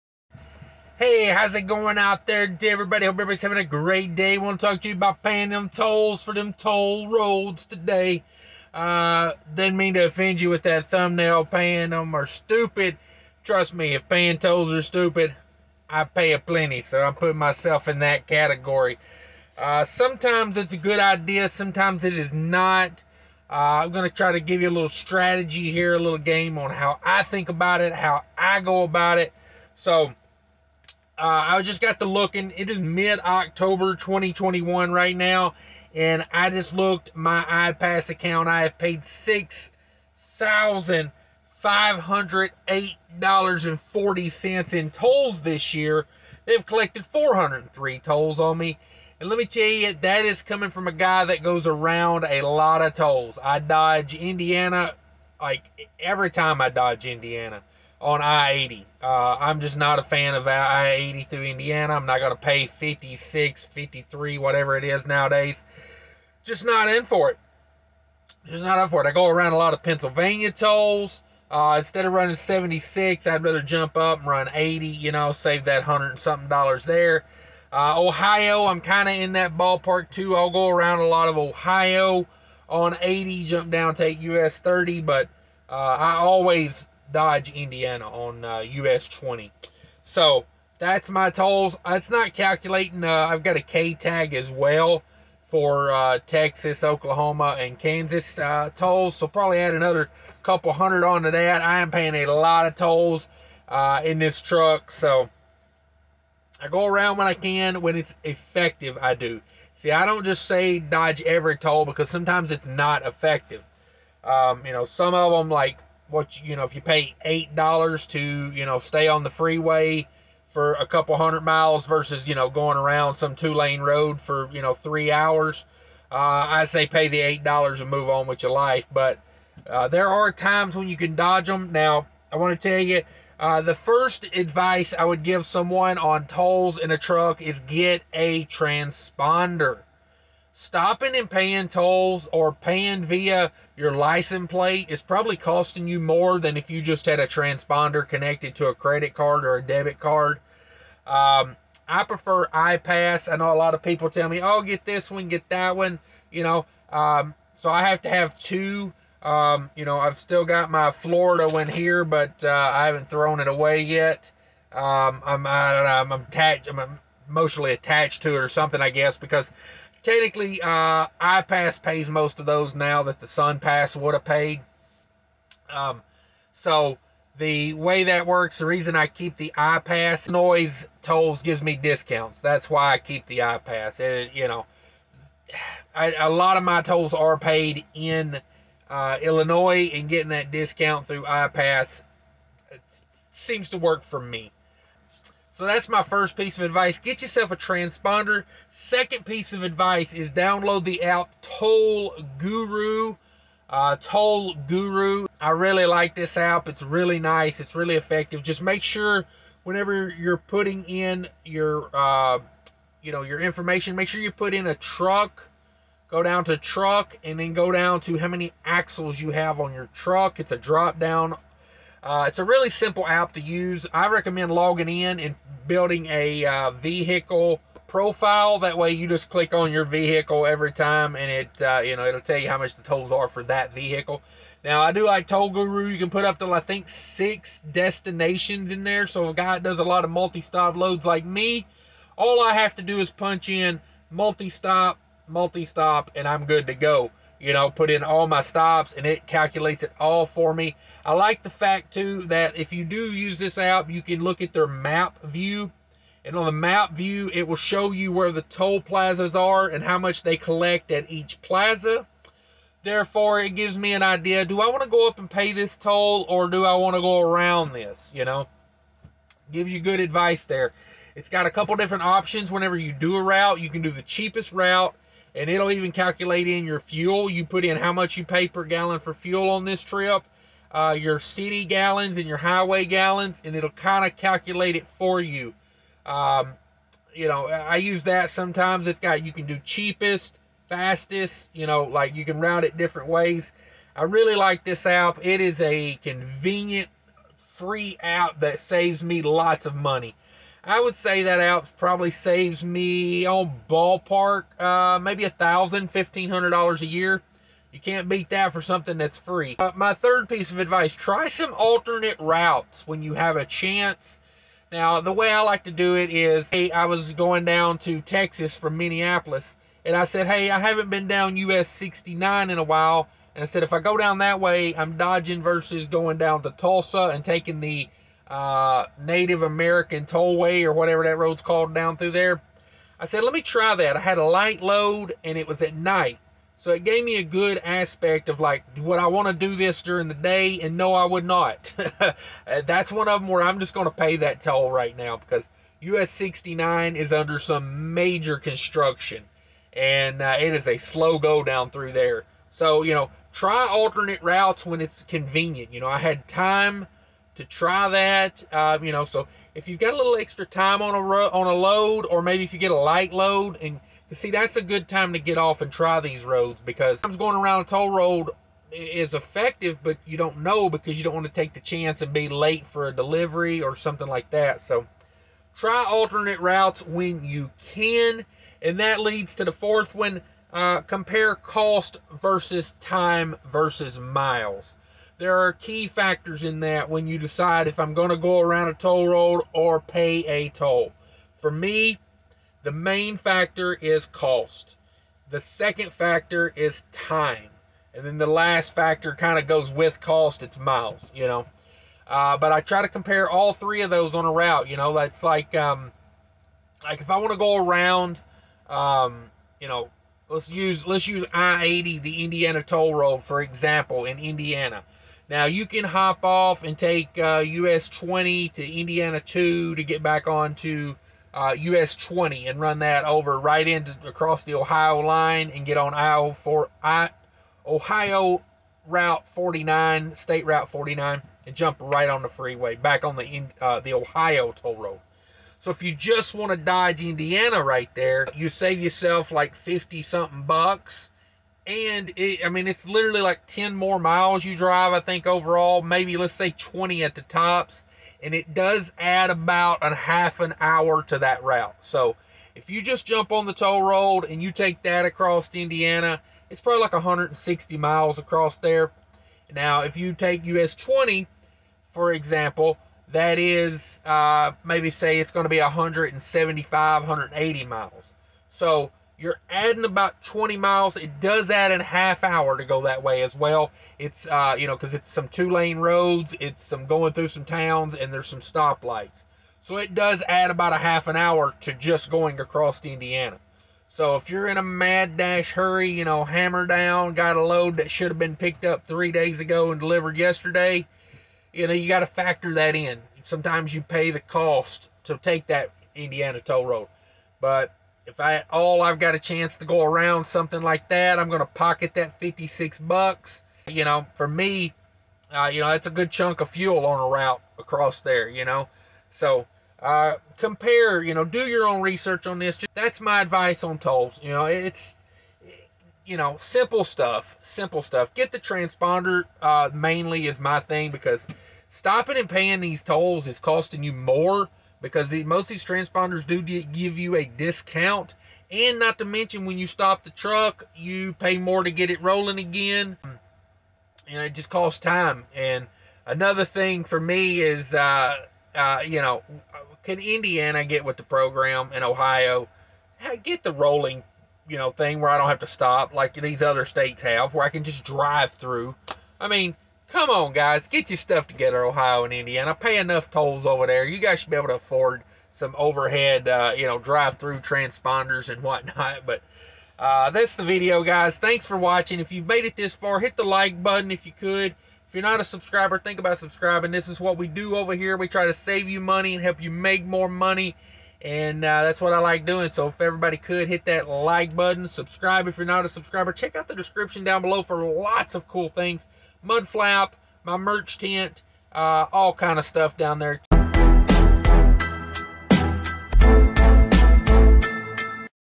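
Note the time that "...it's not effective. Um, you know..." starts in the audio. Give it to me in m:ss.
1:52.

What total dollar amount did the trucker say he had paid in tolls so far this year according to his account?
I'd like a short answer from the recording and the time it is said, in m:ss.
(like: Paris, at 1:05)
$6,508.40, at 0:39.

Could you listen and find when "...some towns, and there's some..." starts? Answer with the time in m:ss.
7:57.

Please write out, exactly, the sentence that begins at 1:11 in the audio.
Uh, instead of running 76, I'd rather jump up and run 80, you know, save that 100 and something dollars there.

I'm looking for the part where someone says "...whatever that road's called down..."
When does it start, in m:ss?
5:30.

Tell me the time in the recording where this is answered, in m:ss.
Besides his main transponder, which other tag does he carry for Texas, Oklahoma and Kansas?
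1:33.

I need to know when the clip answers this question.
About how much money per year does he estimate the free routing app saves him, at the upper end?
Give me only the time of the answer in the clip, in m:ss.
5:05.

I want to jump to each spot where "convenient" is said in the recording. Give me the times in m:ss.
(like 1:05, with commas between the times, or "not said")
4:56, 5:55.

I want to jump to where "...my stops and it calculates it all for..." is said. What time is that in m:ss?
4:08.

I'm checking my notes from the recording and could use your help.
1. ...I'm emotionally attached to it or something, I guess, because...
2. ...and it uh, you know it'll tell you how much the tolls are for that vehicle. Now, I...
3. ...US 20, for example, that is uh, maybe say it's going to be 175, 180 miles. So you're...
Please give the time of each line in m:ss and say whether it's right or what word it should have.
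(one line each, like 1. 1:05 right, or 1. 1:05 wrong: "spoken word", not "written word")
1. 2:46 right
2. 3:51 right
3. 7:40 right.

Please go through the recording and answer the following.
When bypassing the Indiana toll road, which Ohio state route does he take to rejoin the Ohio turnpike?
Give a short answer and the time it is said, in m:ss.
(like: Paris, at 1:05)
Route 49, at 7:10.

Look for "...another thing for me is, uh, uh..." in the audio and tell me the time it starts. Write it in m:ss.
8:56.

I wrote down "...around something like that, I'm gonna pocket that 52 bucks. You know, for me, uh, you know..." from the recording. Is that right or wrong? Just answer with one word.
wrong.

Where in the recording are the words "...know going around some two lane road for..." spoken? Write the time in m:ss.
2:02.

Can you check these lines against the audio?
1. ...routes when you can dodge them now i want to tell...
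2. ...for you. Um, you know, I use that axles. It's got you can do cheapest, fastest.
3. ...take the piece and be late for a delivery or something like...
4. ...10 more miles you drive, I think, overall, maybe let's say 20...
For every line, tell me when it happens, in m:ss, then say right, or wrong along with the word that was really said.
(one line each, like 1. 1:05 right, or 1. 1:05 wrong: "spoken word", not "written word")
1. 2:10 wrong: "times", not "routes"
2. 4:44 wrong: "sometimes", not "axles"
3. 6:11 wrong: "chance", not "piece"
4. 7:23 right.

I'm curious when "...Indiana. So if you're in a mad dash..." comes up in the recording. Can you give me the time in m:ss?
8:02.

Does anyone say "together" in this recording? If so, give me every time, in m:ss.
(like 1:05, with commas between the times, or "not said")
9:11.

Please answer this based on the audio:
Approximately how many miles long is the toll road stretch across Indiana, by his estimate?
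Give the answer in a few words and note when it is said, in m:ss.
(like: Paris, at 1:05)
160, at 7:36.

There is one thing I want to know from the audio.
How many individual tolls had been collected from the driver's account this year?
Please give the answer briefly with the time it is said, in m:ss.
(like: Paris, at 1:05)
403, at 0:47.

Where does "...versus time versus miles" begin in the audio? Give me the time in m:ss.
6:22.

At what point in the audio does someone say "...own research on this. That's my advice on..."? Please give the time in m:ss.
8:31.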